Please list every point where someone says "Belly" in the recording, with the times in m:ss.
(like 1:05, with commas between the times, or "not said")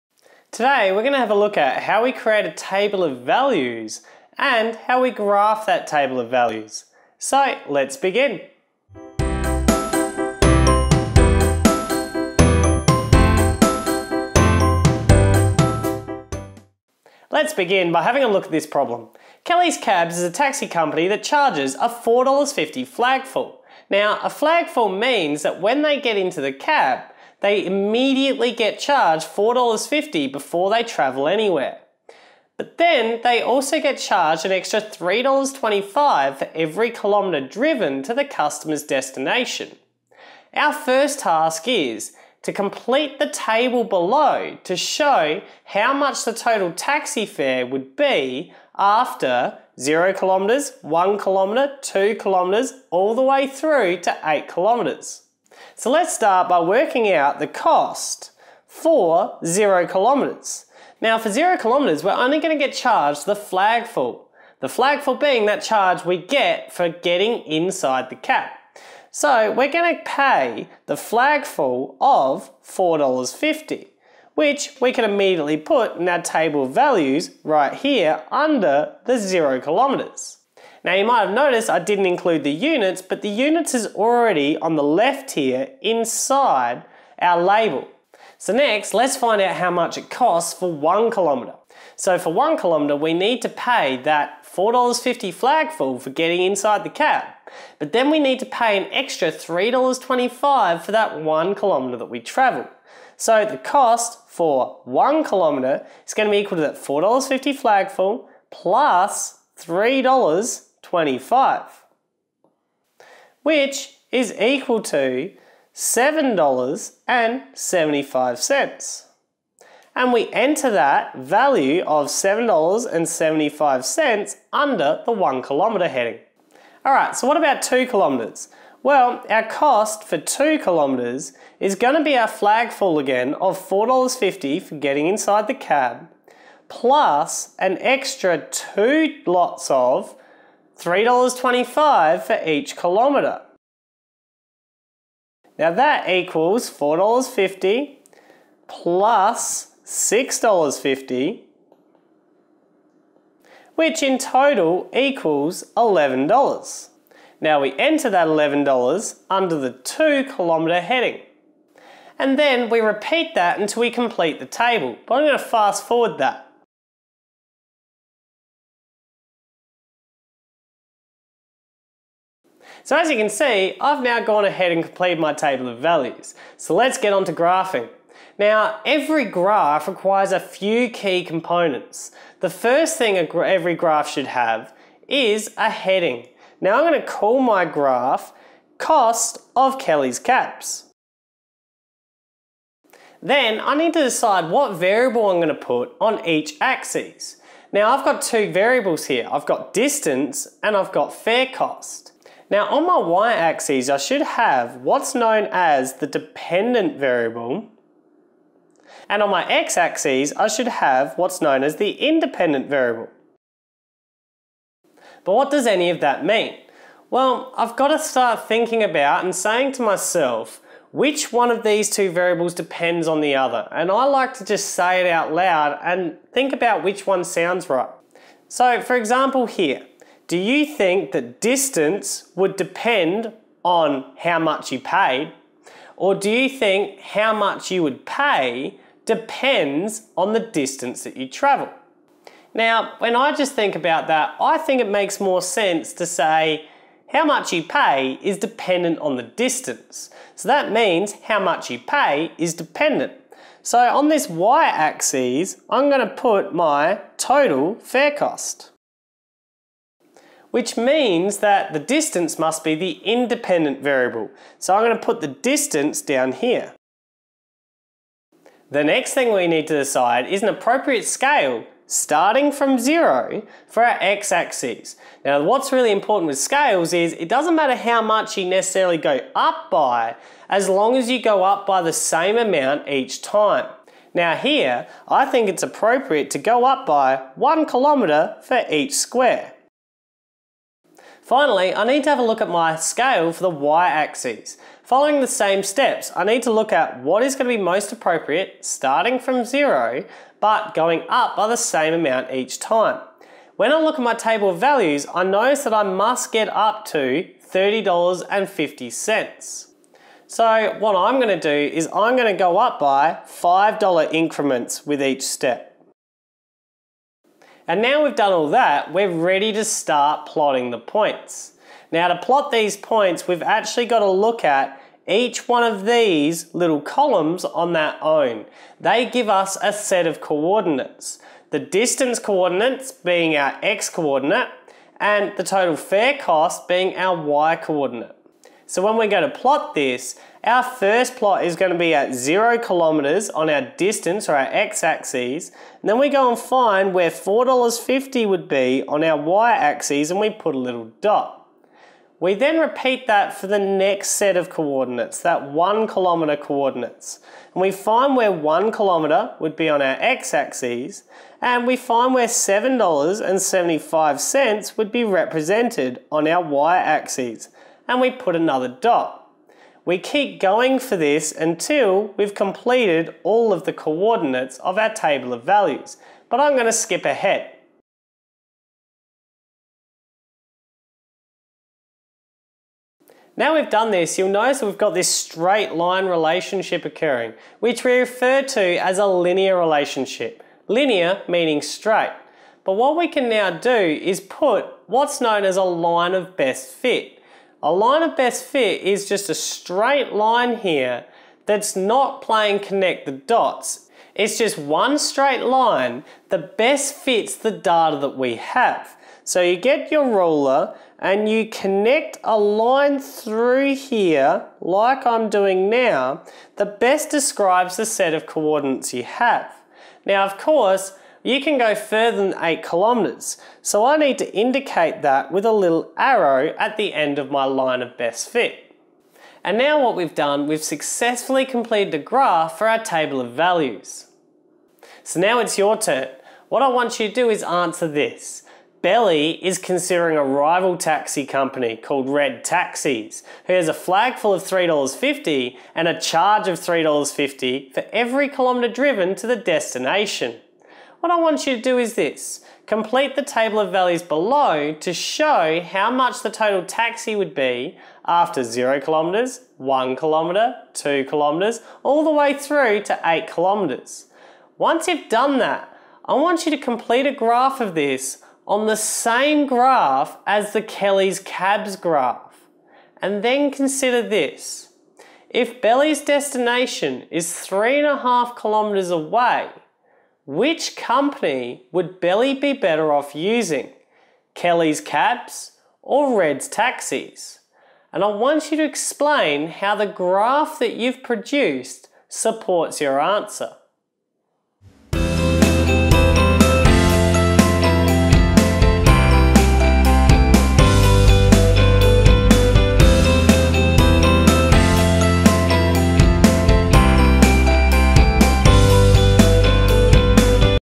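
7:18, 7:55, 8:01.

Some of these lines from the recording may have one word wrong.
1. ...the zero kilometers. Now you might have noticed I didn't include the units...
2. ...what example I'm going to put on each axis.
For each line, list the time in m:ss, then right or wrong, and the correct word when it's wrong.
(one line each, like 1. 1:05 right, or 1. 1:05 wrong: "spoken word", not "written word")
1. 1:19 right
2. 3:14 wrong: "variable", not "example".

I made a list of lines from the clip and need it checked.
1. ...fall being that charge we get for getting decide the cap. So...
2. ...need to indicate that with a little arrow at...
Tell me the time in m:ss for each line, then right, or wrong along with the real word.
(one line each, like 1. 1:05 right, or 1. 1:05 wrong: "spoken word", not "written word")
1. 1:05 wrong: "inside", not "decide"
2. 7:03 right.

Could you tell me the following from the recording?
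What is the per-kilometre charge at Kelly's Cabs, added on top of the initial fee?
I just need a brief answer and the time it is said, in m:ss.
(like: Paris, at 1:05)
$3.25, at 0:34.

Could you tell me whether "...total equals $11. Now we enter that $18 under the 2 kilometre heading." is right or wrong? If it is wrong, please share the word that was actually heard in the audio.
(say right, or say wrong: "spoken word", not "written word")
wrong: "11", not "18".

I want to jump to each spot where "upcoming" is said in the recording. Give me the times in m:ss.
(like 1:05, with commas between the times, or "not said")
not said.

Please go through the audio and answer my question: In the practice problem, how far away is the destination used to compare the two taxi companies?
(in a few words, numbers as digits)
3.5 kilometres.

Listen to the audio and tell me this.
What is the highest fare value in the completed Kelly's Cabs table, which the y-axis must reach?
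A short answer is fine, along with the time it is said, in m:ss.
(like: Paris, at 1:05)
$30.50, at 5:07.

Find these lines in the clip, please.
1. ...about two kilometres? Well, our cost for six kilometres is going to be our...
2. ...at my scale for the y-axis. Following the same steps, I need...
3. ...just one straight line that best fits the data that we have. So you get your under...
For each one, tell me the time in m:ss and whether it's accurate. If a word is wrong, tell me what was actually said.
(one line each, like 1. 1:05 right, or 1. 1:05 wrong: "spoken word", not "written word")
1. 2:07 wrong: "two", not "six"
2. 4:52 right
3. 6:44 wrong: "ruler", not "under".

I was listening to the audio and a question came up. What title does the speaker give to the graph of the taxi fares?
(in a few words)
Cost of Kelly's Cabs.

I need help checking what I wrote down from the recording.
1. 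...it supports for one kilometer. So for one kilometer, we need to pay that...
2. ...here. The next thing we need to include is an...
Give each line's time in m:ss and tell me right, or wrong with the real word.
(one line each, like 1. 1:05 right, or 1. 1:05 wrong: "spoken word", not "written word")
1. 1:29 wrong: "costs", not "supports"
2. 4:26 wrong: "decide", not "include".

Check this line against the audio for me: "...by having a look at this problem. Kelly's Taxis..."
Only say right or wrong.
wrong.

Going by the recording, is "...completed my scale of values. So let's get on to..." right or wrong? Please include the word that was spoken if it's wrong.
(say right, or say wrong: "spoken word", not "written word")
wrong: "table", not "scale".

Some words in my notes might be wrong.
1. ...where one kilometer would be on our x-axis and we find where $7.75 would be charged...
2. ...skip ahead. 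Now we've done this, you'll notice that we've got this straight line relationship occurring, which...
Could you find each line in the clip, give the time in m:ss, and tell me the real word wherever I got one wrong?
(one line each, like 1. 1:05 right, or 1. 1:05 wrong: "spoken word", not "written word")
1. 5:58 wrong: "represented", not "charged"
2. 6:16 right.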